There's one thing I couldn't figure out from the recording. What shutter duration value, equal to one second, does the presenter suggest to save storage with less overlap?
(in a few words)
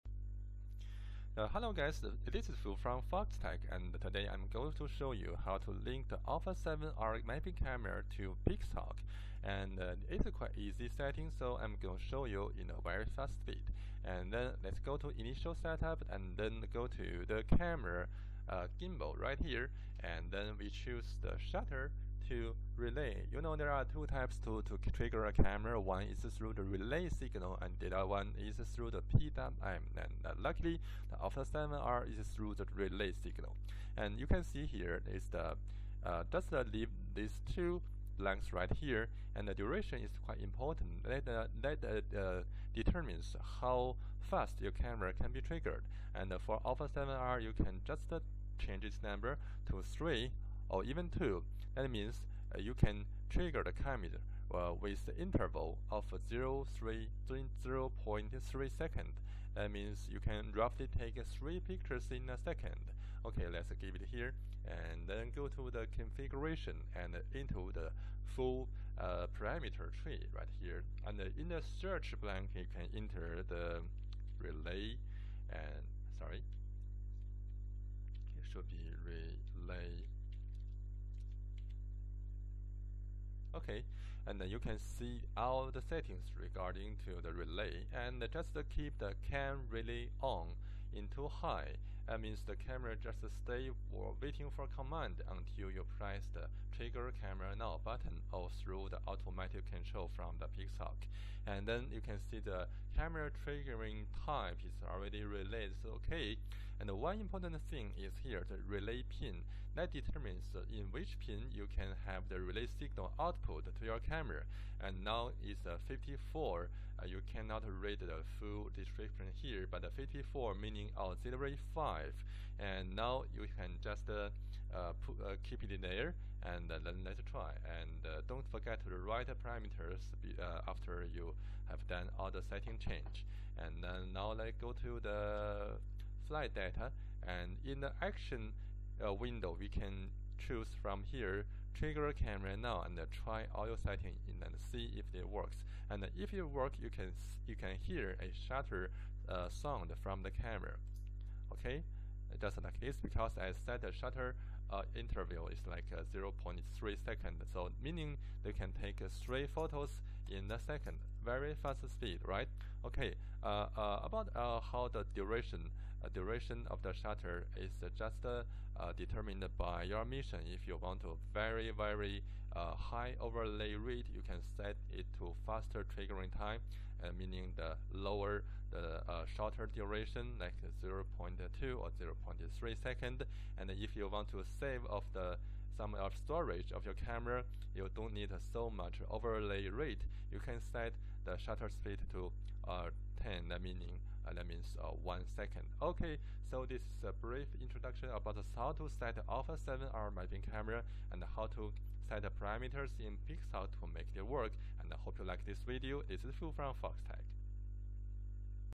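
10.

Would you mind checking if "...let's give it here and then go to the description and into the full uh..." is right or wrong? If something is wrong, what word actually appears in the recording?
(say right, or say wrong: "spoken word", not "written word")
wrong: "configuration", not "description".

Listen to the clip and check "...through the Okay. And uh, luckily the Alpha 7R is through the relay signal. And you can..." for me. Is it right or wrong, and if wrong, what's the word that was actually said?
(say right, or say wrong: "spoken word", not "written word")
wrong: "PWM", not "Okay".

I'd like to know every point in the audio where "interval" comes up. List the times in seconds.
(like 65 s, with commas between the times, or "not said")
55 s, 154 s.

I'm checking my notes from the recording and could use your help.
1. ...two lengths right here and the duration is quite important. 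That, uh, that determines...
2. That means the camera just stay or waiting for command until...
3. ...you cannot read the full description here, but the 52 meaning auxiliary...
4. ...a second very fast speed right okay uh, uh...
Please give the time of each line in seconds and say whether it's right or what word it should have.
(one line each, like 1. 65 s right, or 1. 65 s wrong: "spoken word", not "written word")
1. 37 s right
2. 92 s right
3. 117 s wrong: "54", not "52"
4. 160 s right.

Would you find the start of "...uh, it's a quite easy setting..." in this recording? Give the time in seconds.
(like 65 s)
9 s.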